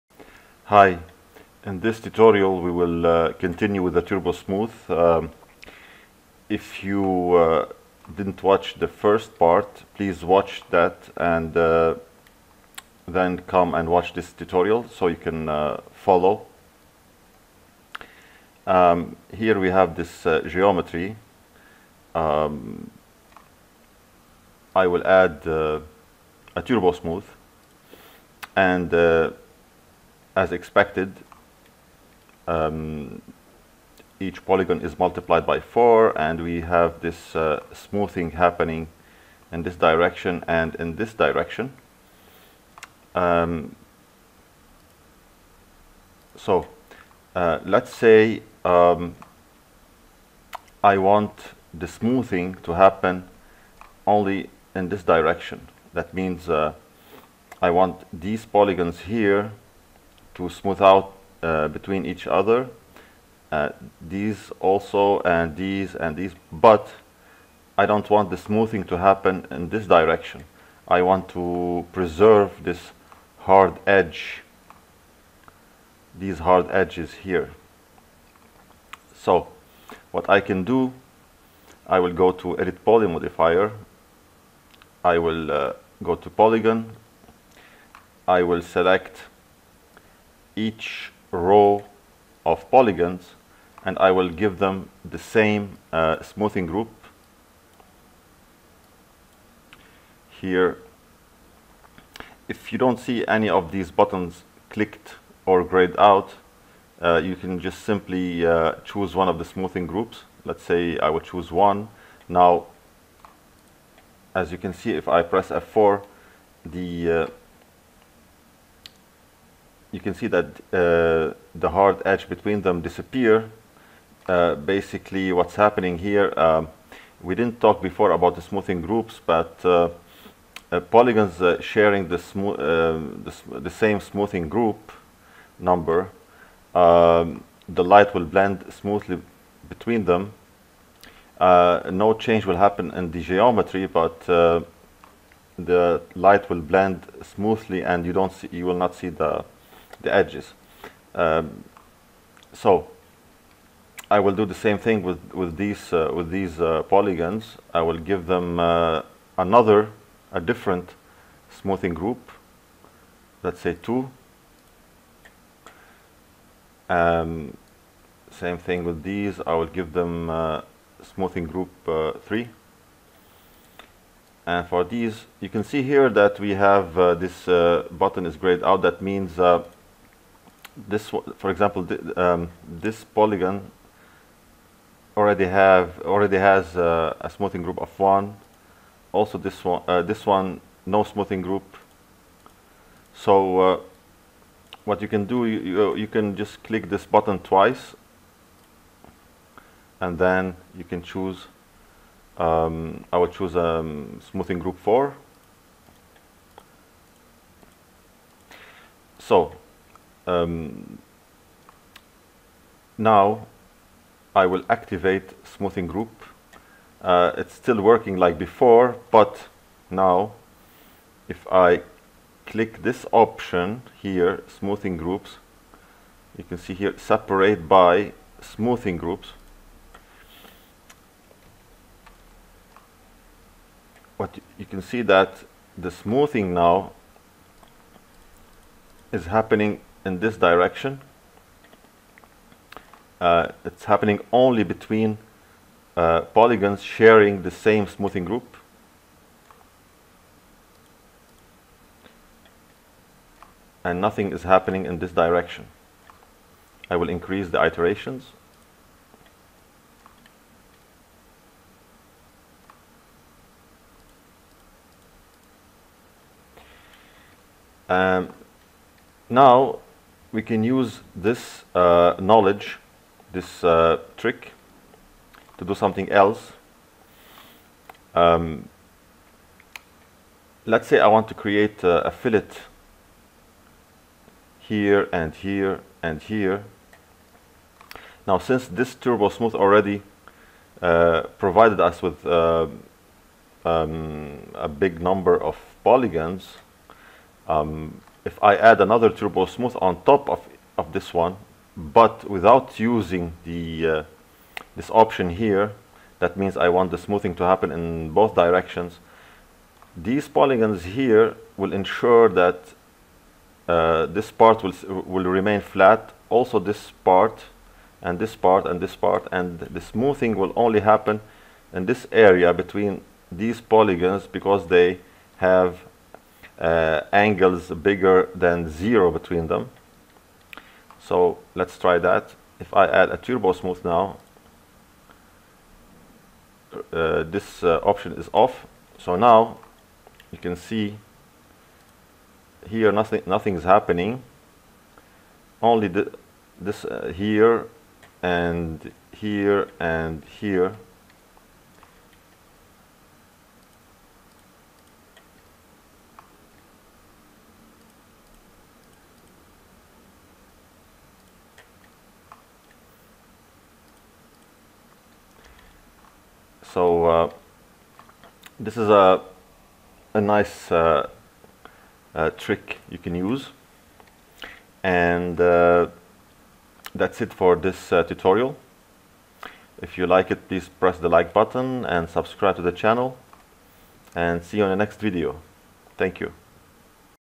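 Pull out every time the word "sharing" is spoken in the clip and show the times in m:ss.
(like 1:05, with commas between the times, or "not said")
2:11, 4:06.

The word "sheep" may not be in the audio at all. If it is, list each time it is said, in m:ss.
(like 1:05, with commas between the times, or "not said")
not said.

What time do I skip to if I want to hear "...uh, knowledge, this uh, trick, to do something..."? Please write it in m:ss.
4:31.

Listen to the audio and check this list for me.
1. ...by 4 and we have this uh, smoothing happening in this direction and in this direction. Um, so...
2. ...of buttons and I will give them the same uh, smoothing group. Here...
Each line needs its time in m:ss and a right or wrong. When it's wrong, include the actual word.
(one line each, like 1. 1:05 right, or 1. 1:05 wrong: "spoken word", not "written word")
1. 0:35 right
2. 1:32 wrong: "polygons", not "buttons".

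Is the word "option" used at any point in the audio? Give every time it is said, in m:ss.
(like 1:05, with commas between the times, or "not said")
3:43, 5:04, 5:37.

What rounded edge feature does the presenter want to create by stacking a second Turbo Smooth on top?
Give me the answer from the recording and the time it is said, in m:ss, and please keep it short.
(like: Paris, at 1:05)
fillet, at 4:42.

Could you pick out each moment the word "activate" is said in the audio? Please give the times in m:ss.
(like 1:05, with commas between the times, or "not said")
3:34.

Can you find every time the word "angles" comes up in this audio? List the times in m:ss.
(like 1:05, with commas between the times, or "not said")
5:27.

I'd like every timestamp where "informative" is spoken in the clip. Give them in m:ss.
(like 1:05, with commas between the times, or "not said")
not said.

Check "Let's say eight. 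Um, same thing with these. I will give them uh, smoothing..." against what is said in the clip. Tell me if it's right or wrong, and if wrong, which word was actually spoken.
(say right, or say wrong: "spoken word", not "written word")
wrong: "two", not "eight".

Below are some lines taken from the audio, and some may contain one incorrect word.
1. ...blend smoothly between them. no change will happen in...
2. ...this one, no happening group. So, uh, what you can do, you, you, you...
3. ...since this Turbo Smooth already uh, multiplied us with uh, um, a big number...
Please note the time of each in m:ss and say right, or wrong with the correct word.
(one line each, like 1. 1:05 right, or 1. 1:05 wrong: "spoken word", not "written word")
1. 2:18 right
2. 3:10 wrong: "smoothing", not "happening"
3. 4:48 wrong: "provided", not "multiplied".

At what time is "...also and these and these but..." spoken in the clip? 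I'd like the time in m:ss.
1:04.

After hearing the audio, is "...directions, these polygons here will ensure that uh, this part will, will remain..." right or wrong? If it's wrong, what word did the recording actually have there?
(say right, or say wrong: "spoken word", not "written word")
right.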